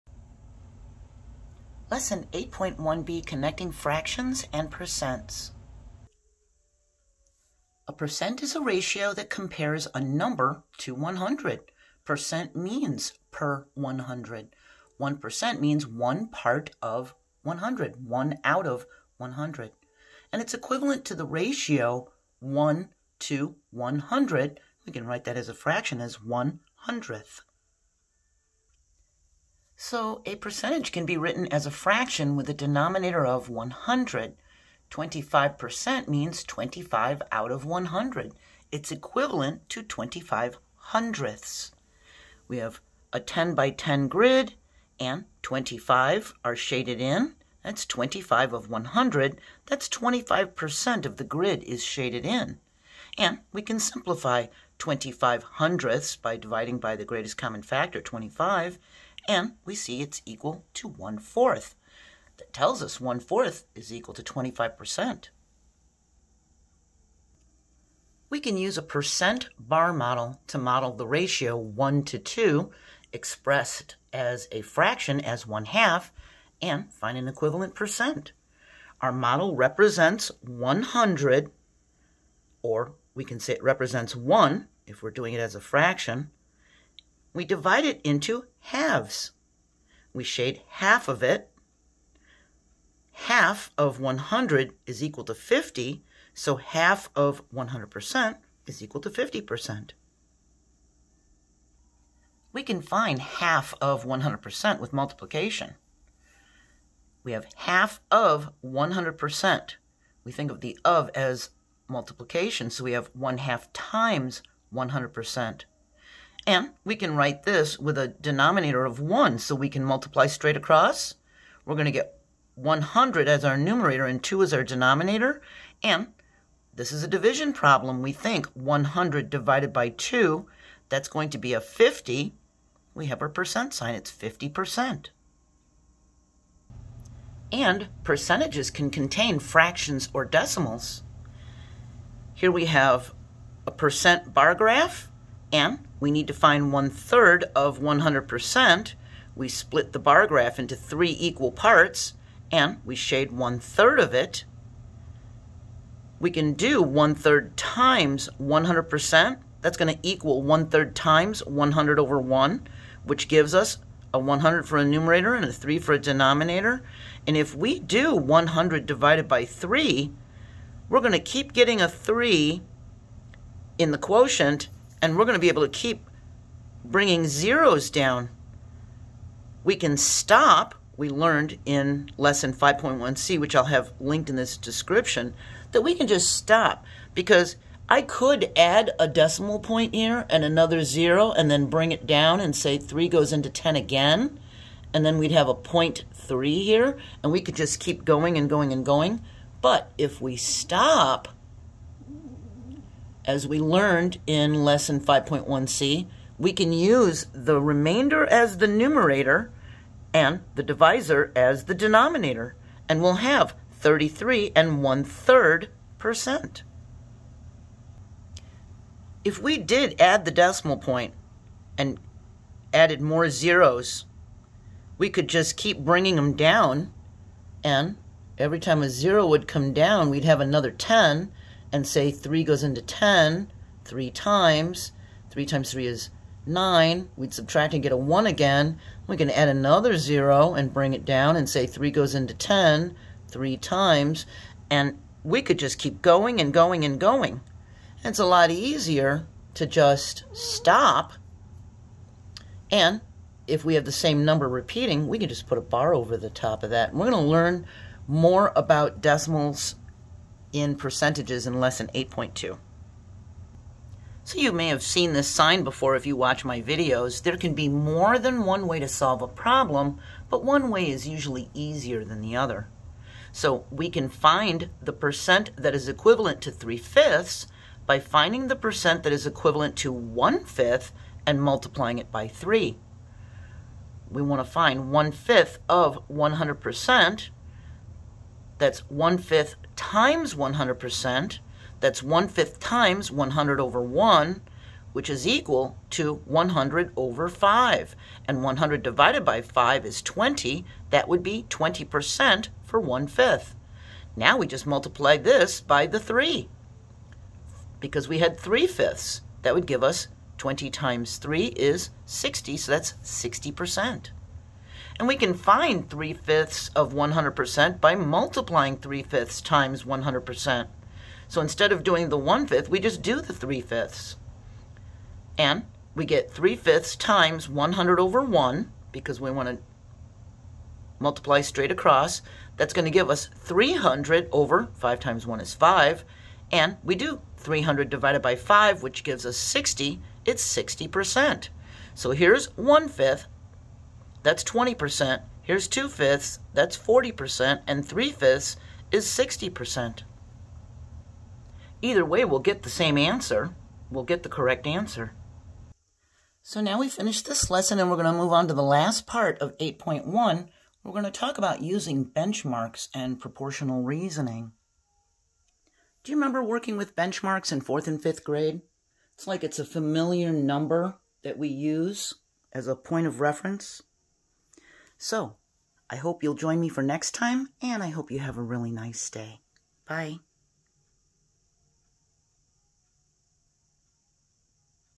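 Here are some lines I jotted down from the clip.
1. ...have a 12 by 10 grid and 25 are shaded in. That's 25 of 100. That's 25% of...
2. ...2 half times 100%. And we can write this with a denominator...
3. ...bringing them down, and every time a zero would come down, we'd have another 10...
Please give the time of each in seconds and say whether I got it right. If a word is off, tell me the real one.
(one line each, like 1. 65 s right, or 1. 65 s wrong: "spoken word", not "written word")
1. 42 s wrong: "10", not "12"
2. 113 s wrong: "1", not "2"
3. 225 s right.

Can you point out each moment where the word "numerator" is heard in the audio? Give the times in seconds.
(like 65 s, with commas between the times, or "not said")
123 s, 164 s, 208 s.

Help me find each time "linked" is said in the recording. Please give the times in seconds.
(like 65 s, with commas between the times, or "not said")
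183 s.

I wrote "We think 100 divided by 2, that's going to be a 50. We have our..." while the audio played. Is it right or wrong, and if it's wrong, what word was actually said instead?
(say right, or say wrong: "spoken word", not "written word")
right.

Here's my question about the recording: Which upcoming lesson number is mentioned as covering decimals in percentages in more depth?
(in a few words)
8.2.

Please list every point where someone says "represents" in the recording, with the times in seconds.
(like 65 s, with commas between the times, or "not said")
79 s, 83 s.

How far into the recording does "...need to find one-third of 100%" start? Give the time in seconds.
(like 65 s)
146 s.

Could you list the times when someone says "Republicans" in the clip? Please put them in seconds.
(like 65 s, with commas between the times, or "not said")
not said.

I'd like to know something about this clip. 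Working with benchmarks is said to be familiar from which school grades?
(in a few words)
fourth and fifth grade.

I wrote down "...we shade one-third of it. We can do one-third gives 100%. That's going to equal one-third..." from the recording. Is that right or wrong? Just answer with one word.
wrong.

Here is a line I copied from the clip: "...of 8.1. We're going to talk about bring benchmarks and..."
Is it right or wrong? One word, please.
wrong.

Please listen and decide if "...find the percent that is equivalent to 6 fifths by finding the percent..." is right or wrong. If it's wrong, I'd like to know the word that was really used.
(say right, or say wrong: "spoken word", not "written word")
wrong: "3", not "6".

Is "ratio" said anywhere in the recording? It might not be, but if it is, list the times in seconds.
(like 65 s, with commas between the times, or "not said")
8 s, 21 s, 71 s.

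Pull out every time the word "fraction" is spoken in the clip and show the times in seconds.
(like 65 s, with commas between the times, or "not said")
3 s, 25 s, 31 s, 74 s, 85 s, 139 s.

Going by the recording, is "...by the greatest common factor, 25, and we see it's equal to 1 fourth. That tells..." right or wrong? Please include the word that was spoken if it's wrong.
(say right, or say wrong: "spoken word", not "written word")
right.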